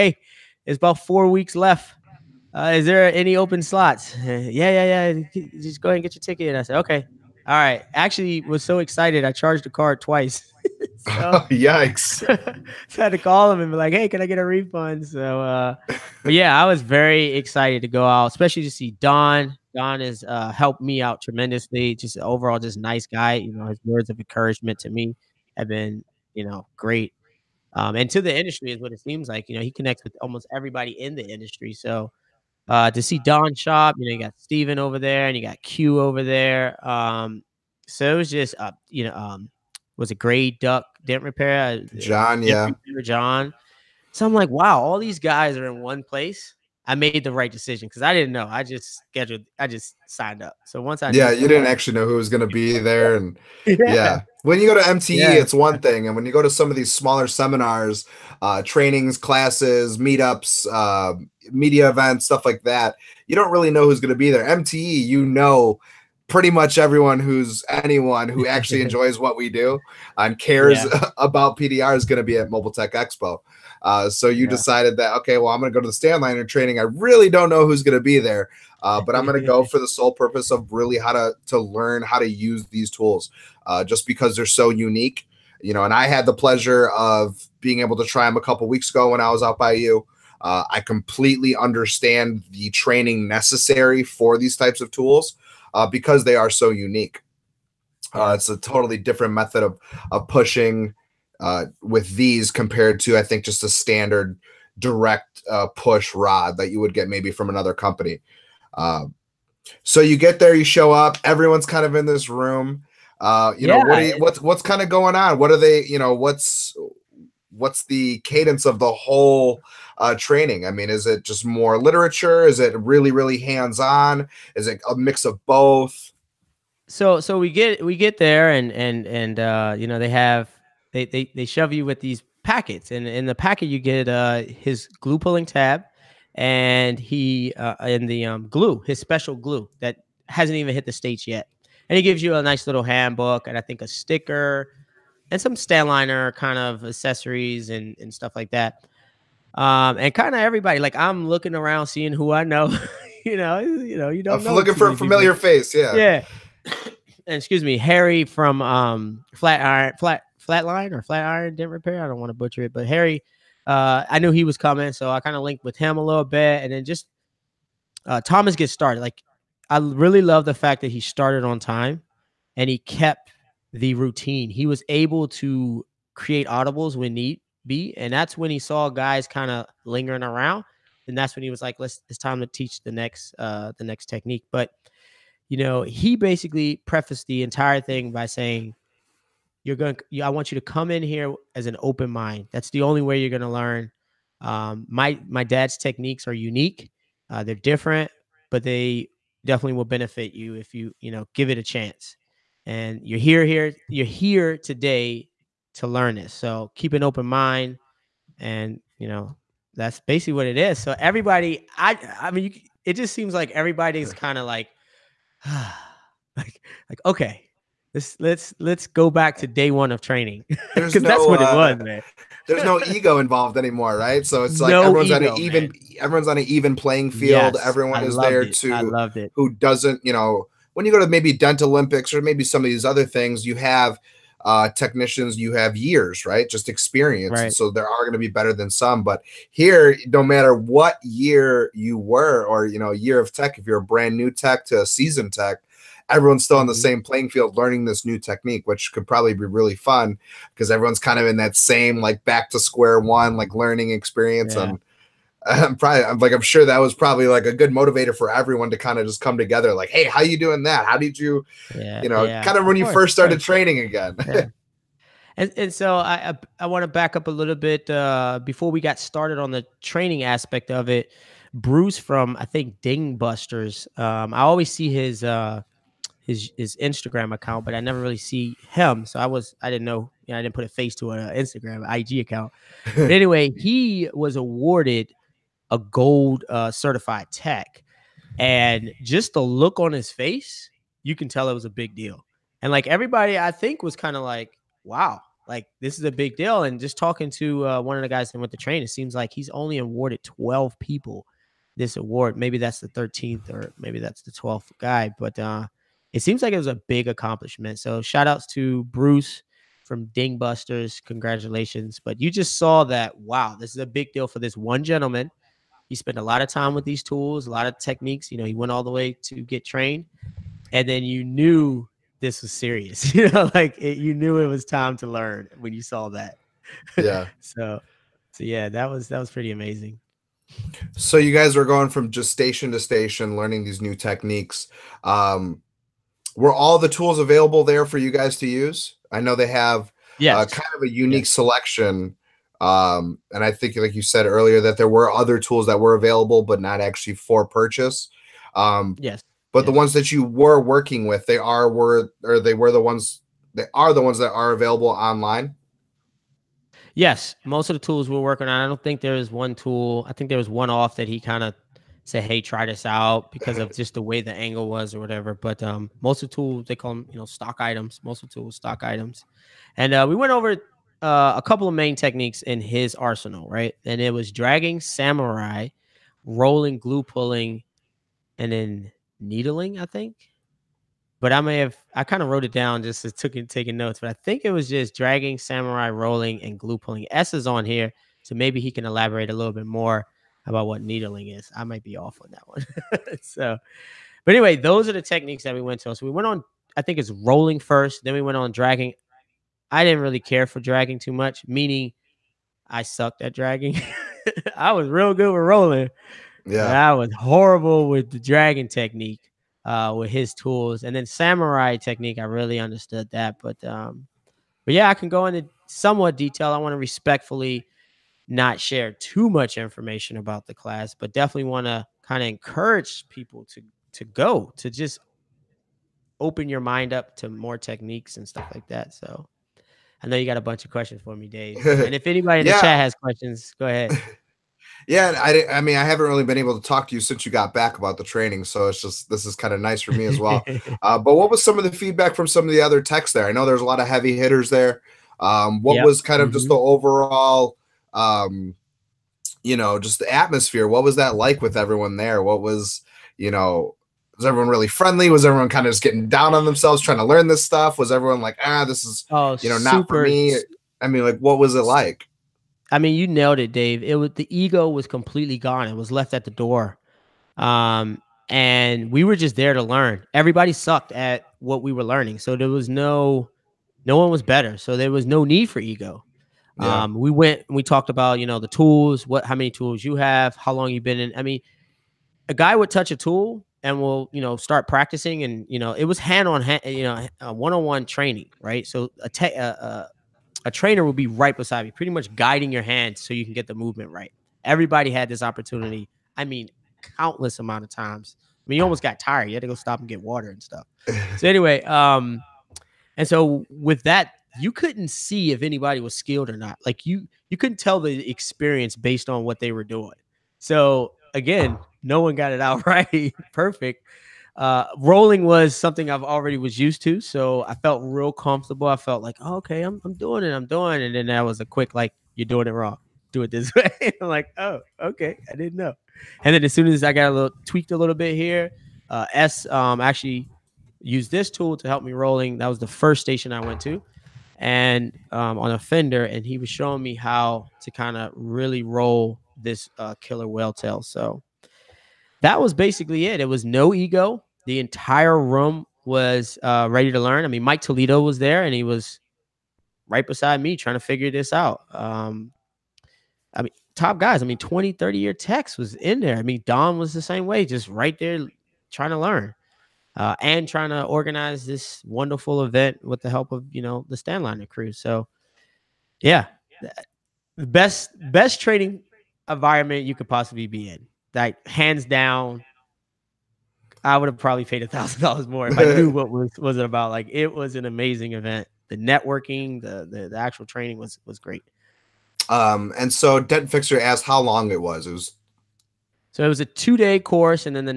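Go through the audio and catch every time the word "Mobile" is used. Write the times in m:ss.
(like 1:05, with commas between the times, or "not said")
1:12.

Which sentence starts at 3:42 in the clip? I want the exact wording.
There's no ego involved anymore, right?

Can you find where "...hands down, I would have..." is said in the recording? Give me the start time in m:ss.
9:31.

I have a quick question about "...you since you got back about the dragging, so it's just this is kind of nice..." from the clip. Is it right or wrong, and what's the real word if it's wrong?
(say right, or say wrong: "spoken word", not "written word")
wrong: "training", not "dragging".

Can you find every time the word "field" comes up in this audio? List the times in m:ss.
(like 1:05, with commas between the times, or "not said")
3:47, 4:07.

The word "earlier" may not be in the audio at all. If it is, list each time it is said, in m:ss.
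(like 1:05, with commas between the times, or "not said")
5:44.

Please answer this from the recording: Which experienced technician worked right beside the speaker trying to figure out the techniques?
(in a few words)
Mike Toledo.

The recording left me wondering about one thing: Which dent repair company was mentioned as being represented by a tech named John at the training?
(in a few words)
Gray Duck Dent Repair.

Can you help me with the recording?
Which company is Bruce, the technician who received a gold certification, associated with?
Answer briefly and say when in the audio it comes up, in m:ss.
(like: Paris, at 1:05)
Dingbusters, at 5:10.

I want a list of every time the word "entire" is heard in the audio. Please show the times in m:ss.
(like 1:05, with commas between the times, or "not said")
3:07, 9:04.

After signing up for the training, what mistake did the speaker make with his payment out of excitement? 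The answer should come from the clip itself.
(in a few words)
Charged the card twice.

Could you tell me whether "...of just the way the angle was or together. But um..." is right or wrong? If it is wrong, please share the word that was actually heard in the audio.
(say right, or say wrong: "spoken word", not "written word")
wrong: "whatever", not "together".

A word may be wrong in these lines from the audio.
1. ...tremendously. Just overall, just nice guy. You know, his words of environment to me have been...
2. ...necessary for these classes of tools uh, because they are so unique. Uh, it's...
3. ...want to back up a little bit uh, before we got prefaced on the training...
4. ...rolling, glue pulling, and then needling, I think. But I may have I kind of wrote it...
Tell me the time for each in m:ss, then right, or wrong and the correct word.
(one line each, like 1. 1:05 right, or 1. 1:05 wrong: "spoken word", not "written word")
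1. 0:21 wrong: "encouragement", not "environment"
2. 1:33 wrong: "types", not "classes"
3. 4:26 wrong: "started", not "prefaced"
4. 6:16 right.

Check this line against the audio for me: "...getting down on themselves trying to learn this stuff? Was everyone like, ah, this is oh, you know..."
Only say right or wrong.
right.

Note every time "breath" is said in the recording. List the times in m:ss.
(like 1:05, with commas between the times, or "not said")
not said.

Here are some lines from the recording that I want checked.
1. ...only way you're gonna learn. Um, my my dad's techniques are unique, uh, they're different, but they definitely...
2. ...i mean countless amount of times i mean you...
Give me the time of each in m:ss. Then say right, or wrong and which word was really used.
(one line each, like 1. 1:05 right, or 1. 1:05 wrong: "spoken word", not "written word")
1. 3:12 right
2. 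8:16 right.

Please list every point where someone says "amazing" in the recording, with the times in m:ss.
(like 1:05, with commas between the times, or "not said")
5:29, 9:37.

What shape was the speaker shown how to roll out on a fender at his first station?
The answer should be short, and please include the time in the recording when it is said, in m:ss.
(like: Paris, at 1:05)
Killer whale tail, at 9:00.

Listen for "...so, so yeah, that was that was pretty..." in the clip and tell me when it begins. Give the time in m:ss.
5:27.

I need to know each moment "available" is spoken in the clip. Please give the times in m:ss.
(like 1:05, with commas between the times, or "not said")
5:37, 5:45, 5:54.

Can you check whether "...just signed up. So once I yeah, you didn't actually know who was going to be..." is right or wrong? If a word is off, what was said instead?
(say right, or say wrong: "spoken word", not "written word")
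right.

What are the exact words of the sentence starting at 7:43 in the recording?
It was the ego was completely gone.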